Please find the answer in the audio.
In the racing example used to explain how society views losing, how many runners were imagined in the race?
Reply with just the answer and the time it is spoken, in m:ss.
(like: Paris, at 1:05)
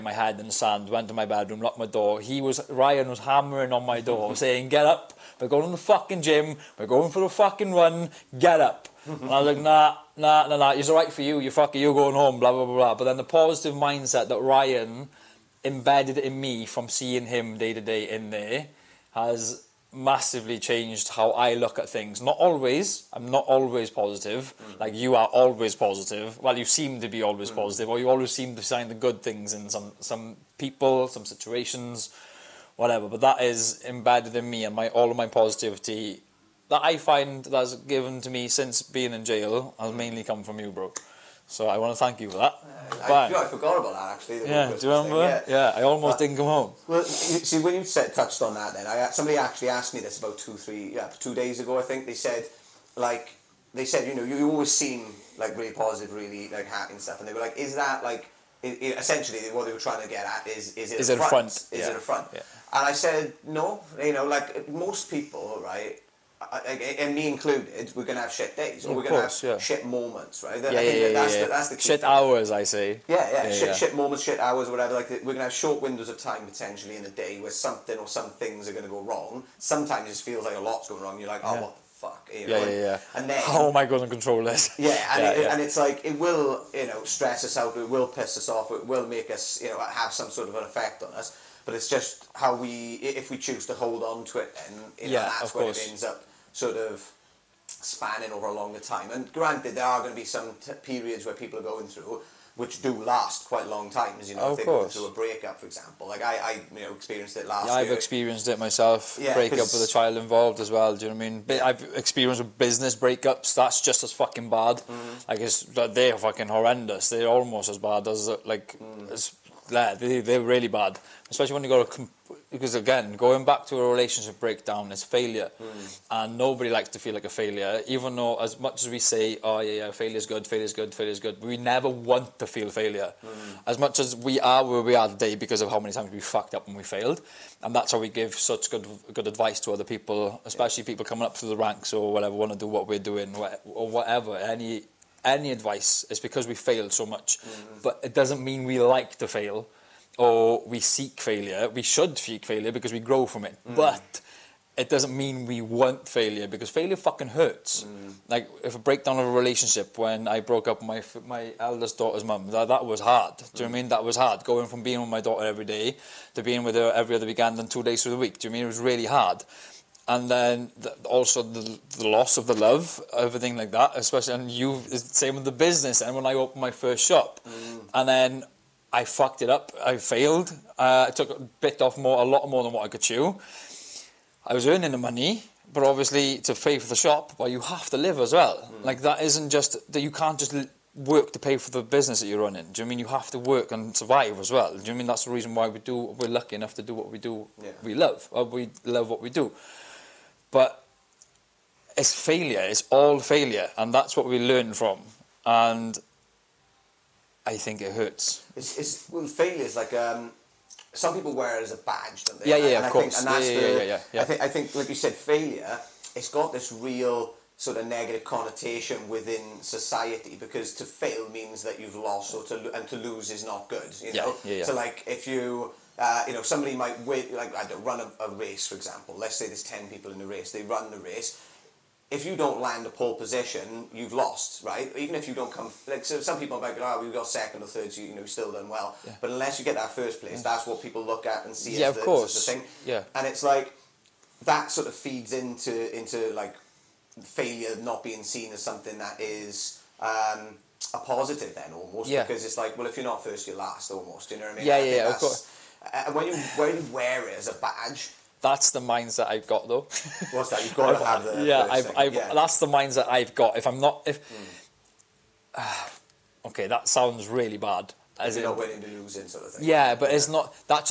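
10, at 3:49.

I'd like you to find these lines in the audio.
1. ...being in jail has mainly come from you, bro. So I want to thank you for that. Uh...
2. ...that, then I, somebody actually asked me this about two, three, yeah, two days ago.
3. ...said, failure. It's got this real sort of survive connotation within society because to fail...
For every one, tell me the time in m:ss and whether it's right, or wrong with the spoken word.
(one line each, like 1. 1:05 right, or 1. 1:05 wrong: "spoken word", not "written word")
1. 0:38 right
2. 0:48 right
3. 3:34 wrong: "negative", not "survive".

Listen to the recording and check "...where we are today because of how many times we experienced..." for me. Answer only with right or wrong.
wrong.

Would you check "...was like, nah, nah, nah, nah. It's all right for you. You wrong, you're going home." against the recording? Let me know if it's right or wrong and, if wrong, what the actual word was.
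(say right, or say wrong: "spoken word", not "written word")
wrong: "fucking", not "wrong".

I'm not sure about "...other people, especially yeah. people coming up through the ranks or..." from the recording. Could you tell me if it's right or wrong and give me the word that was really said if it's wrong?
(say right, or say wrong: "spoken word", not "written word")
right.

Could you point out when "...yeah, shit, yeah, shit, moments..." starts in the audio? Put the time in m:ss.
1:13.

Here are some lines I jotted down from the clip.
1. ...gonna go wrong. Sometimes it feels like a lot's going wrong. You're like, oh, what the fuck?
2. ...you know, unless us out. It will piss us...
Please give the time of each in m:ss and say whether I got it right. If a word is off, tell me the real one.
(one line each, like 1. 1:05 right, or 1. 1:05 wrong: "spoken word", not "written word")
1. 1:18 right
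2. 1:26 wrong: "stress", not "unless".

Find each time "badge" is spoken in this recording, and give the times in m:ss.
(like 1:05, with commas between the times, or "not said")
3:31, 4:17.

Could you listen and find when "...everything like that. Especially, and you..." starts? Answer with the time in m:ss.
2:53.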